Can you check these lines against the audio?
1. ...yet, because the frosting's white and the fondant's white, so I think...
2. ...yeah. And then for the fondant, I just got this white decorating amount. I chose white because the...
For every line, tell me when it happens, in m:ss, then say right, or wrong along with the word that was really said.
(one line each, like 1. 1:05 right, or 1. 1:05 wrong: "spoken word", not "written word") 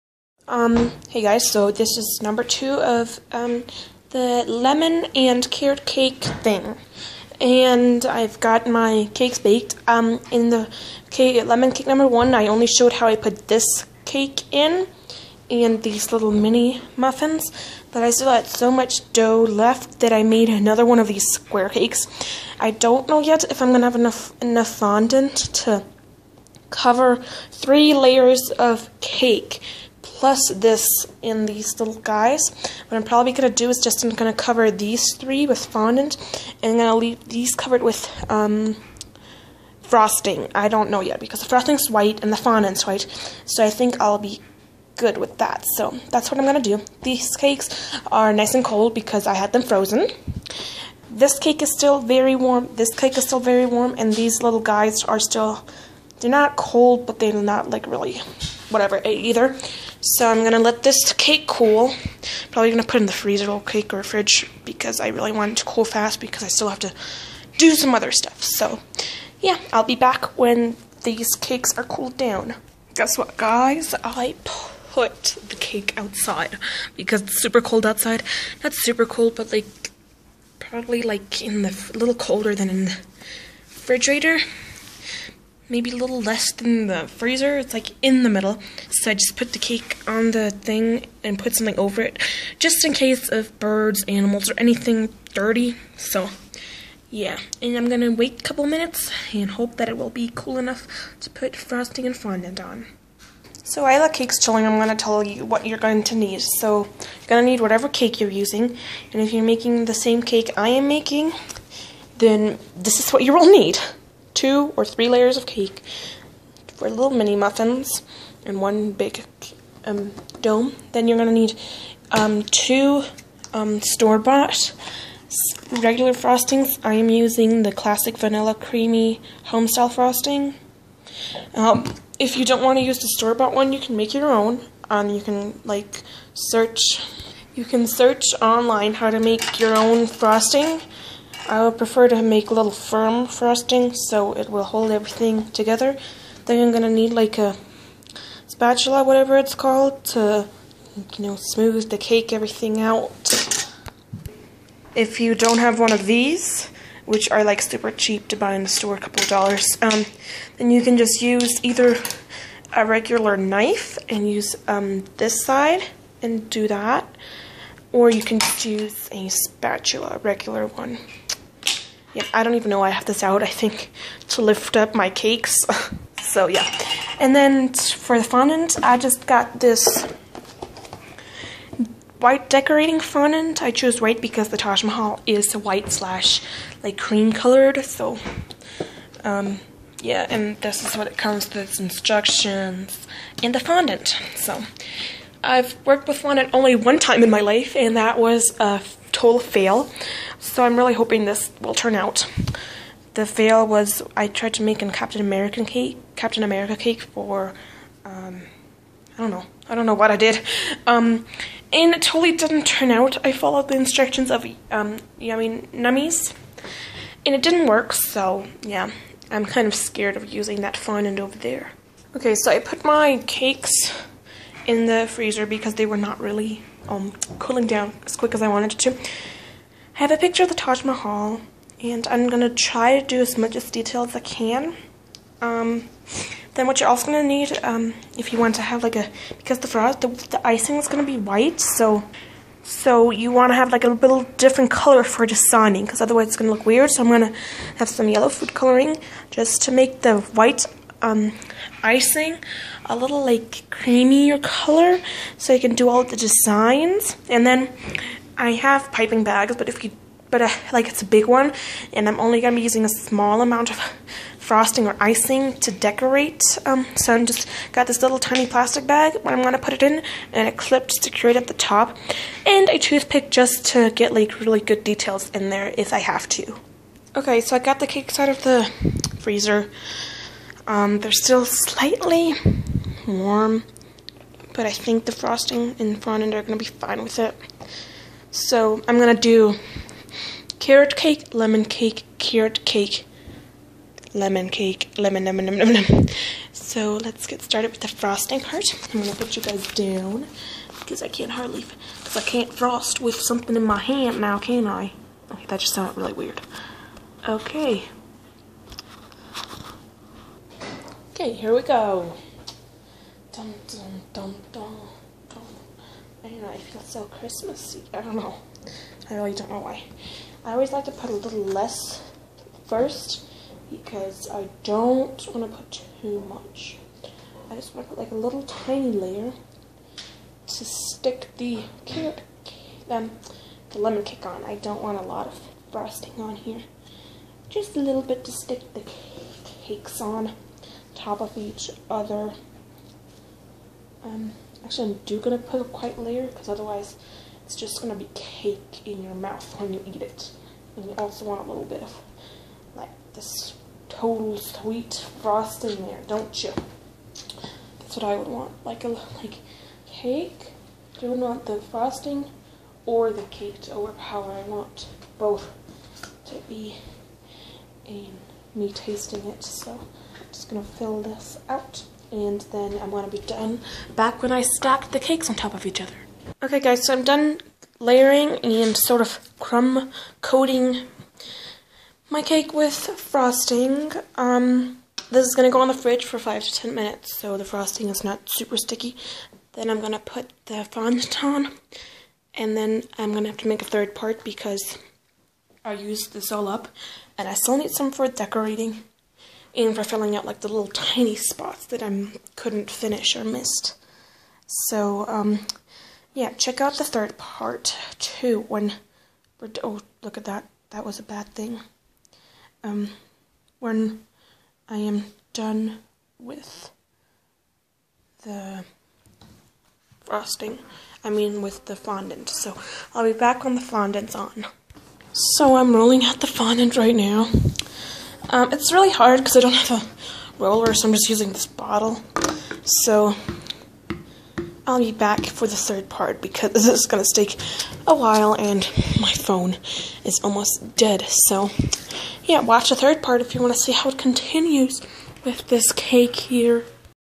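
1. 0:41 right
2. 2:56 wrong: "fondant", not "amount".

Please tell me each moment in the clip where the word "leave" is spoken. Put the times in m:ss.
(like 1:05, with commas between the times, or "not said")
0:36.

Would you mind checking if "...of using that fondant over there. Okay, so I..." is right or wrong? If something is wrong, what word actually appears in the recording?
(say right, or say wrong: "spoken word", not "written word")
right.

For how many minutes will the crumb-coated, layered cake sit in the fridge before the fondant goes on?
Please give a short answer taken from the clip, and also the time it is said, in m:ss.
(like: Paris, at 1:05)
5 to 10 minutes, at 6:26.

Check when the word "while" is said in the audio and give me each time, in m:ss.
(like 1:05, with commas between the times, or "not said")
1:43, 7:17.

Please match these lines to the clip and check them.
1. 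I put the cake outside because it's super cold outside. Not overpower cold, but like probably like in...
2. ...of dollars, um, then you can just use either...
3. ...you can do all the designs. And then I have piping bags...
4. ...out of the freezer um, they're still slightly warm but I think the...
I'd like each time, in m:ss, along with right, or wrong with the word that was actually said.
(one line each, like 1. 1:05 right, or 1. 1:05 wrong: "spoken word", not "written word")
1. 1:14 wrong: "super", not "overpower"
2. 2:39 right
3. 4:15 right
4. 4:38 right.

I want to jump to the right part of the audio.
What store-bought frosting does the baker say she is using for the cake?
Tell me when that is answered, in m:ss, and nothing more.
2:07.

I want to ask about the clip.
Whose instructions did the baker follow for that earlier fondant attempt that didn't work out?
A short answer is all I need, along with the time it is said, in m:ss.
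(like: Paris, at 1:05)
Yummy Nummies, at 3:35.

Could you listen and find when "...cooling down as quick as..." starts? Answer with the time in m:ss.
3:47.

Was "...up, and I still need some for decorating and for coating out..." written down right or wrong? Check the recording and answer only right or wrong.
wrong.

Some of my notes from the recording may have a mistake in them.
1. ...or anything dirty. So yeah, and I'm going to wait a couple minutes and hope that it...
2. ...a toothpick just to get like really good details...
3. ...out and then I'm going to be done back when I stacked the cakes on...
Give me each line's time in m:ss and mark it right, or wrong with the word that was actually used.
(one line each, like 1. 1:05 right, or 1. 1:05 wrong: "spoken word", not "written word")
1. 1:34 right
2. 4:32 right
3. 6:11 right.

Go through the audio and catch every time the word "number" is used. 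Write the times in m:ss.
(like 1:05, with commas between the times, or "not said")
0:02, 0:11.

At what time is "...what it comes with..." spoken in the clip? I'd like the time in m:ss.
3:10.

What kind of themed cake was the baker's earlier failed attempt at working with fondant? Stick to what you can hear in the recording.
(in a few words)
Captain America cake.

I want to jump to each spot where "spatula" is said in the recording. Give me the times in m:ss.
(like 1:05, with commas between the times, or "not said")
2:28, 2:49.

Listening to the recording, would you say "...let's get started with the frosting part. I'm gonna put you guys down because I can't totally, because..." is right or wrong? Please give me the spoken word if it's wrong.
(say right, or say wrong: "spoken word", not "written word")
wrong: "hardly", not "totally".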